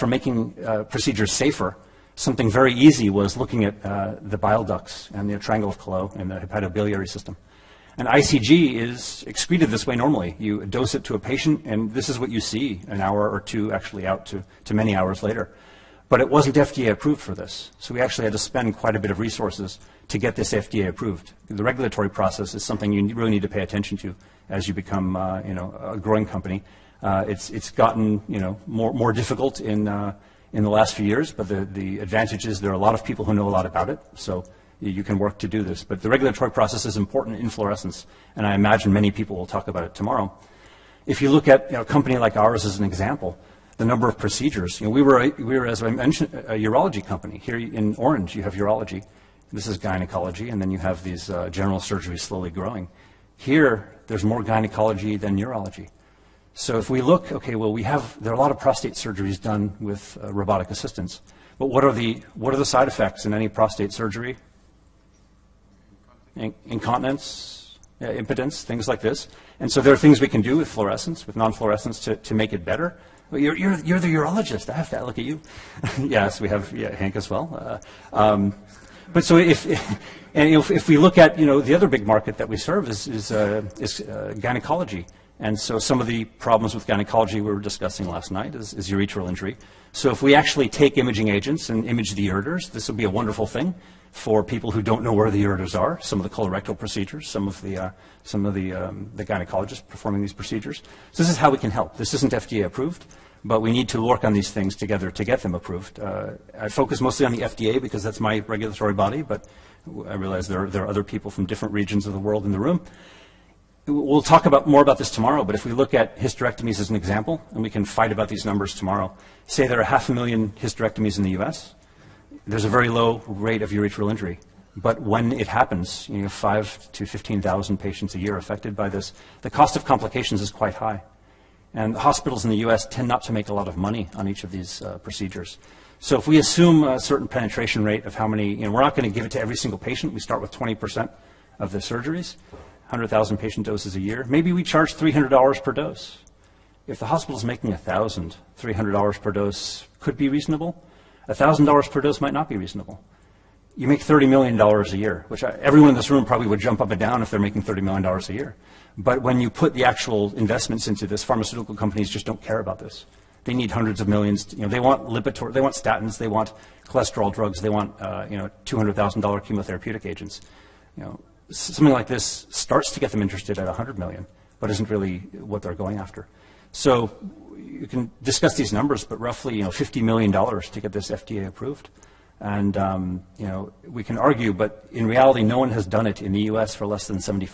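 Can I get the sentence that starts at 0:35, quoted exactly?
But the regulatory process is important in fluorescence, and I imagine many people will talk about it tomorrow.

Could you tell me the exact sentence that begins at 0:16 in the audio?
But it wasn't FDA approved for this.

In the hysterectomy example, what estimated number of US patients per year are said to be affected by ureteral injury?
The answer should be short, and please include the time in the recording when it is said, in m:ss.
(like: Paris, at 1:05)
5,000 to 15,000, at 2:06.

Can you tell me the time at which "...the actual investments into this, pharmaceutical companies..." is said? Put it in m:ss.
2:39.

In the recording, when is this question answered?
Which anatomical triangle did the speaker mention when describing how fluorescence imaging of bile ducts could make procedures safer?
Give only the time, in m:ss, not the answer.
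0:05.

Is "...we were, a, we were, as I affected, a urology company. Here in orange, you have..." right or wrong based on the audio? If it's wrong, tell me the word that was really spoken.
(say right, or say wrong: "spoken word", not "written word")
wrong: "mentioned", not "affected".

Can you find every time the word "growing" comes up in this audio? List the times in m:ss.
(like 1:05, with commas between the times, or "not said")
0:25, 0:52.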